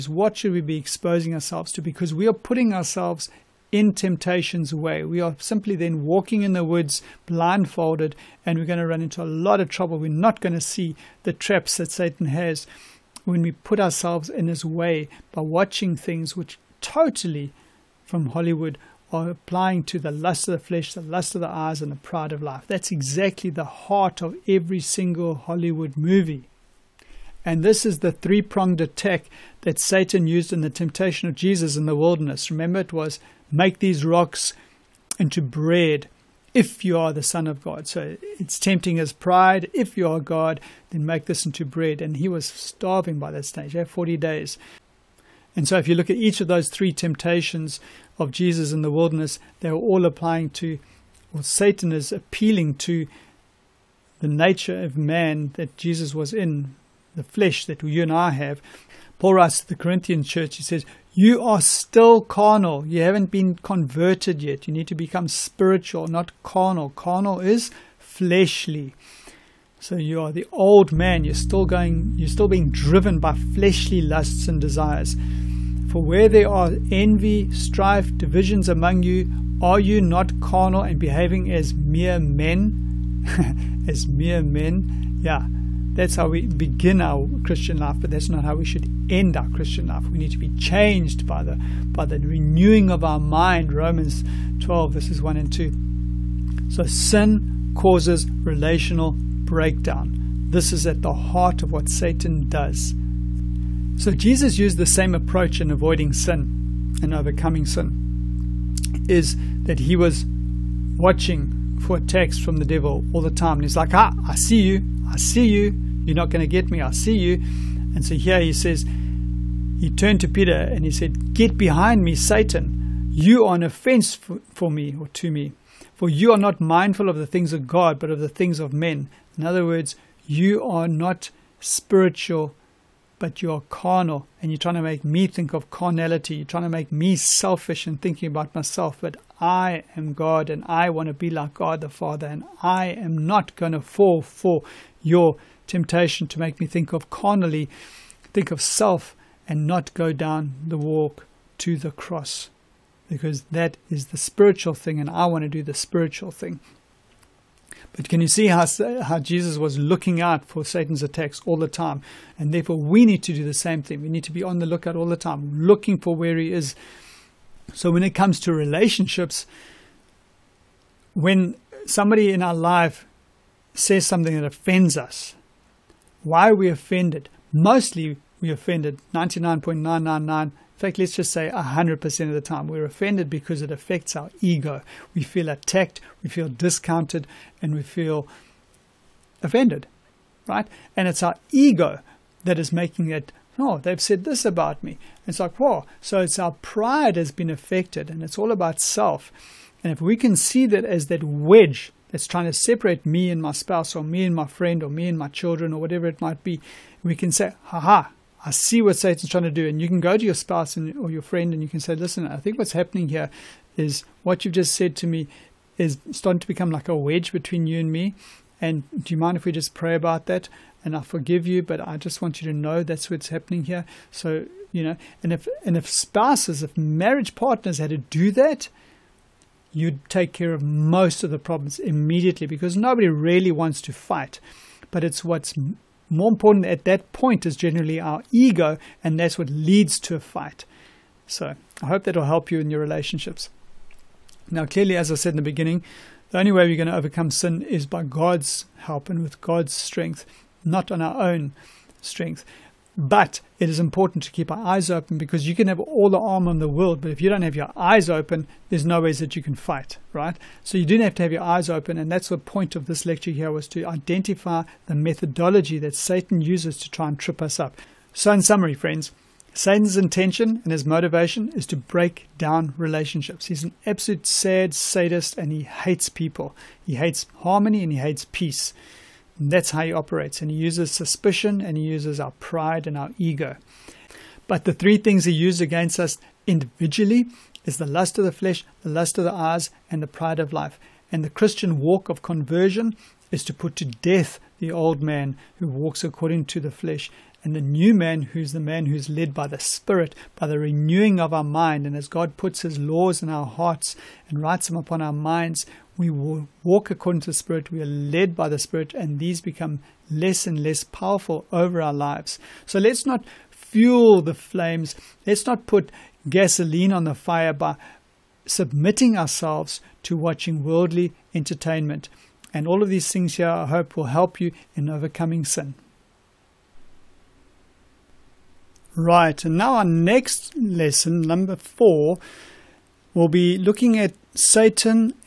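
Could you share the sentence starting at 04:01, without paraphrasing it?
So I hope that'll help you in your relationships.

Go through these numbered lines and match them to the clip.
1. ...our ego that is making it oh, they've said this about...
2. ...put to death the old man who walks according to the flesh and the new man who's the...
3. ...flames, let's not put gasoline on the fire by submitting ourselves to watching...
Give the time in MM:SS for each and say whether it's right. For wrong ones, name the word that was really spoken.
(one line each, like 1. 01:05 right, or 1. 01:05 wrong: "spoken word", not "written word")
1. 03:11 right
2. 04:53 right
3. 05:14 right.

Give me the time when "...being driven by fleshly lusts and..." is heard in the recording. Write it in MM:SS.
01:12.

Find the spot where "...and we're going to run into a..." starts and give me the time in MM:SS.
00:08.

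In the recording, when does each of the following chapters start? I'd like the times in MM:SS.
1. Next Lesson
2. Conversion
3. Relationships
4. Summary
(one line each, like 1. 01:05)
1. 05:25
2. 00:55
3. 01:34
4. 04:25.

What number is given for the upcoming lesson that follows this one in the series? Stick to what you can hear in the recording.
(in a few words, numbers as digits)
4.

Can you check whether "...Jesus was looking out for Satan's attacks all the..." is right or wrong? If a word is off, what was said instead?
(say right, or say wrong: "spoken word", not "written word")
right.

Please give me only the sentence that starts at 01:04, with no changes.
You need to become spiritual, not carnal.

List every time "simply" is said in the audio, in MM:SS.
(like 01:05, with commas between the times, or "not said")
00:05.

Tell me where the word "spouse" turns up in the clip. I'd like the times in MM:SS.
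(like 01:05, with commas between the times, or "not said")
03:23, 03:30, 03:45.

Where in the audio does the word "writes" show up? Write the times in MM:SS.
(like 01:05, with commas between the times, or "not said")
00:59, 05:04.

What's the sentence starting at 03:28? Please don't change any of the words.
I see what Satan's trying to do.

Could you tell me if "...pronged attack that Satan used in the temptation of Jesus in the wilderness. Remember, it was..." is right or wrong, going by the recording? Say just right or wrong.
right.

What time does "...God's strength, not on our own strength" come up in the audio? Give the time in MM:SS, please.
04:09.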